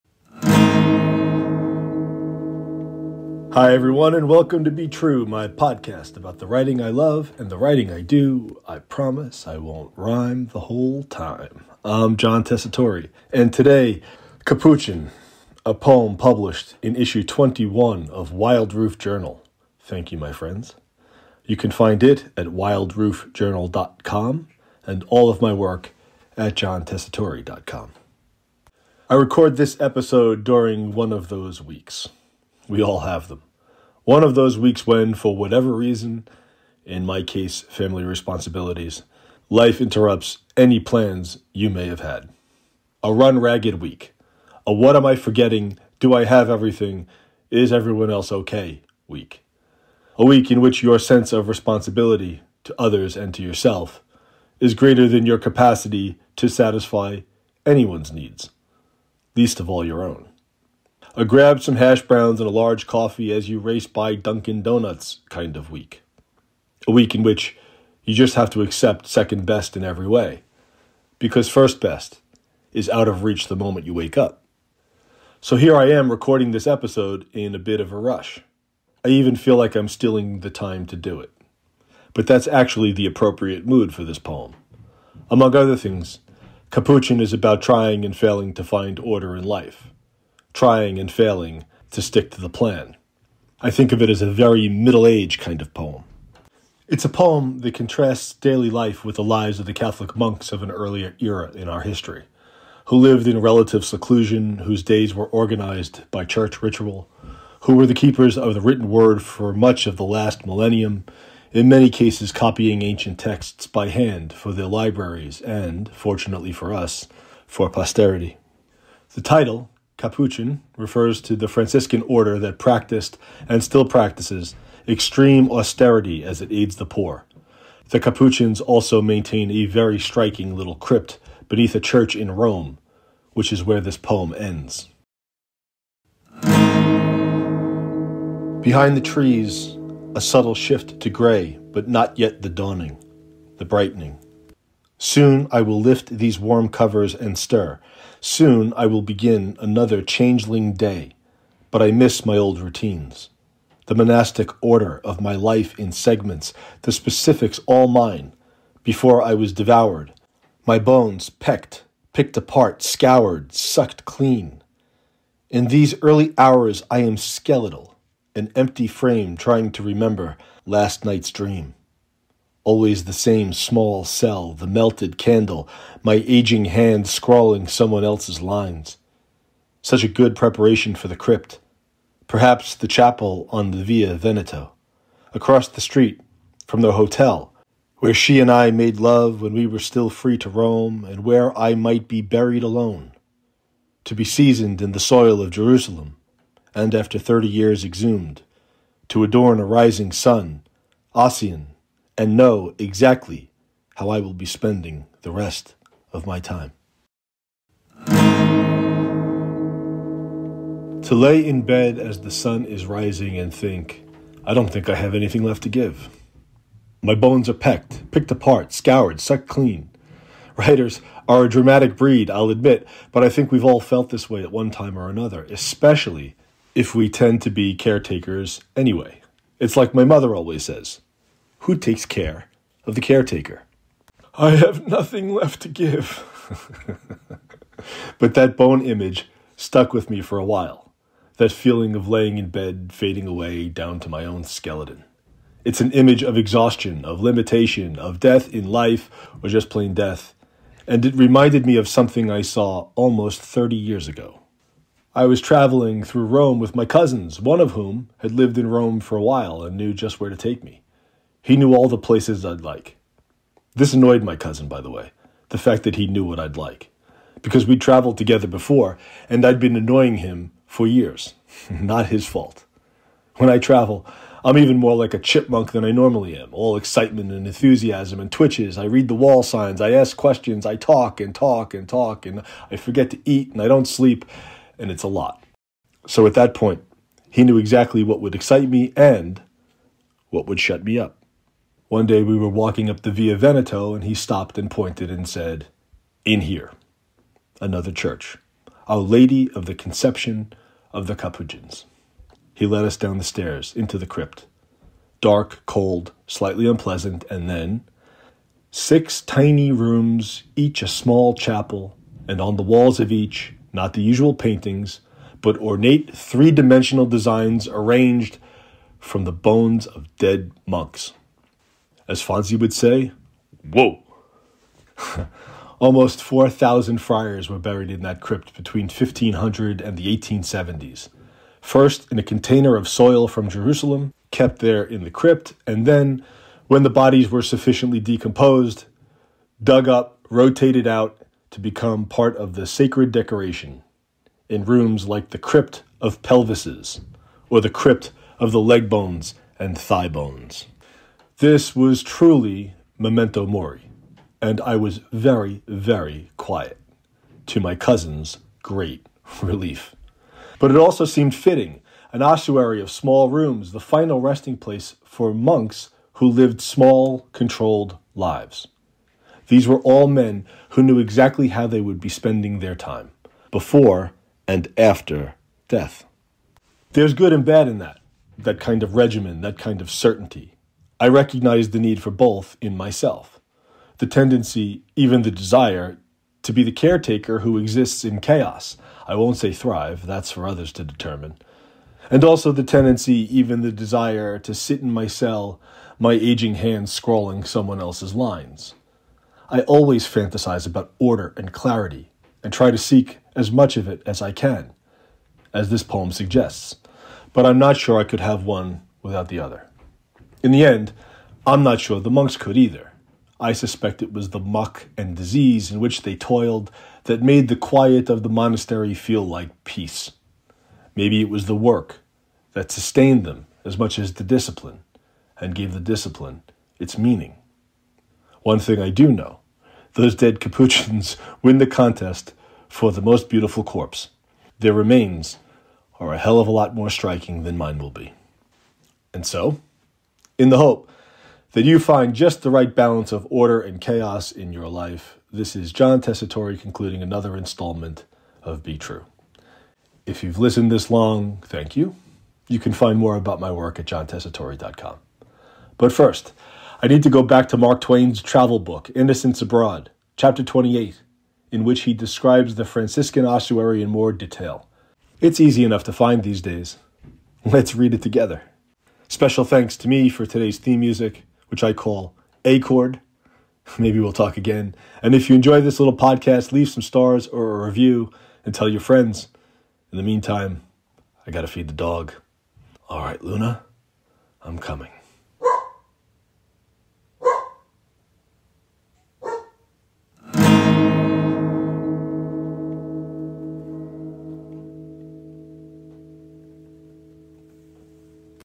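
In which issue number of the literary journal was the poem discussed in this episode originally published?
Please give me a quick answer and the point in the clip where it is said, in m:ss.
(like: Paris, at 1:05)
21, at 0:17.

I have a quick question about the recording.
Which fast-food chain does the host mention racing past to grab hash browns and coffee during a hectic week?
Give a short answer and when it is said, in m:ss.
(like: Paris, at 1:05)
Dunkin' Donuts, at 1:04.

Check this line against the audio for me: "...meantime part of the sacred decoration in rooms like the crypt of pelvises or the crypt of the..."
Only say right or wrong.
wrong.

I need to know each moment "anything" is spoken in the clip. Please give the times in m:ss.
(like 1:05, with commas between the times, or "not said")
3:35.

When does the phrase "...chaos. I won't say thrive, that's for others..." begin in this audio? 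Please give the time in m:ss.
6:28.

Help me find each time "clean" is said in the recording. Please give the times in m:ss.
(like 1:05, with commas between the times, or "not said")
2:44, 3:39.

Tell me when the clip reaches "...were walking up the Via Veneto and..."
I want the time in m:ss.
4:52.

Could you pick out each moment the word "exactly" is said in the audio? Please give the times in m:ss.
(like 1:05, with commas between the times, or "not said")
3:22, 4:47, 6:10.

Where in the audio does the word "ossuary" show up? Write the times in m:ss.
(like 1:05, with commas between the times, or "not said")
6:02, 7:43.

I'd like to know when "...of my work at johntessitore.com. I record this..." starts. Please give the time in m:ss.
0:25.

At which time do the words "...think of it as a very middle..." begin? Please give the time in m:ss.
1:33.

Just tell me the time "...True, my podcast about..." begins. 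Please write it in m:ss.
0:04.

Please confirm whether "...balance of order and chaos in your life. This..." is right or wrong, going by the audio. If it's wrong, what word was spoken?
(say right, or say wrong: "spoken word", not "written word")
right.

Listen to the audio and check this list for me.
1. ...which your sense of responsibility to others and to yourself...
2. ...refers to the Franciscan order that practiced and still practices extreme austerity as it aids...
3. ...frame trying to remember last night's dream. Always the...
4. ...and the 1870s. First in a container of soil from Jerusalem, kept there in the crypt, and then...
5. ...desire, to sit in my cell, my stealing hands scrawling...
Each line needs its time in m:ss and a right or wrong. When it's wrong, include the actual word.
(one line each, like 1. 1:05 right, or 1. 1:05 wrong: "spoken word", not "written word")
1. 0:50 right
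2. 2:00 right
3. 2:48 right
4. 5:29 right
5. 6:33 wrong: "aging", not "stealing".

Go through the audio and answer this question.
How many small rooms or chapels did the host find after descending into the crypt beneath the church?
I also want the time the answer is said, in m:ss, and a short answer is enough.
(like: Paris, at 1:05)
6, at 5:08.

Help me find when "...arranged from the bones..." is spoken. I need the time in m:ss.
5:17.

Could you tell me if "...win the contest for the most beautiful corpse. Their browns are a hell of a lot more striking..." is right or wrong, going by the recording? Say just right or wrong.
wrong.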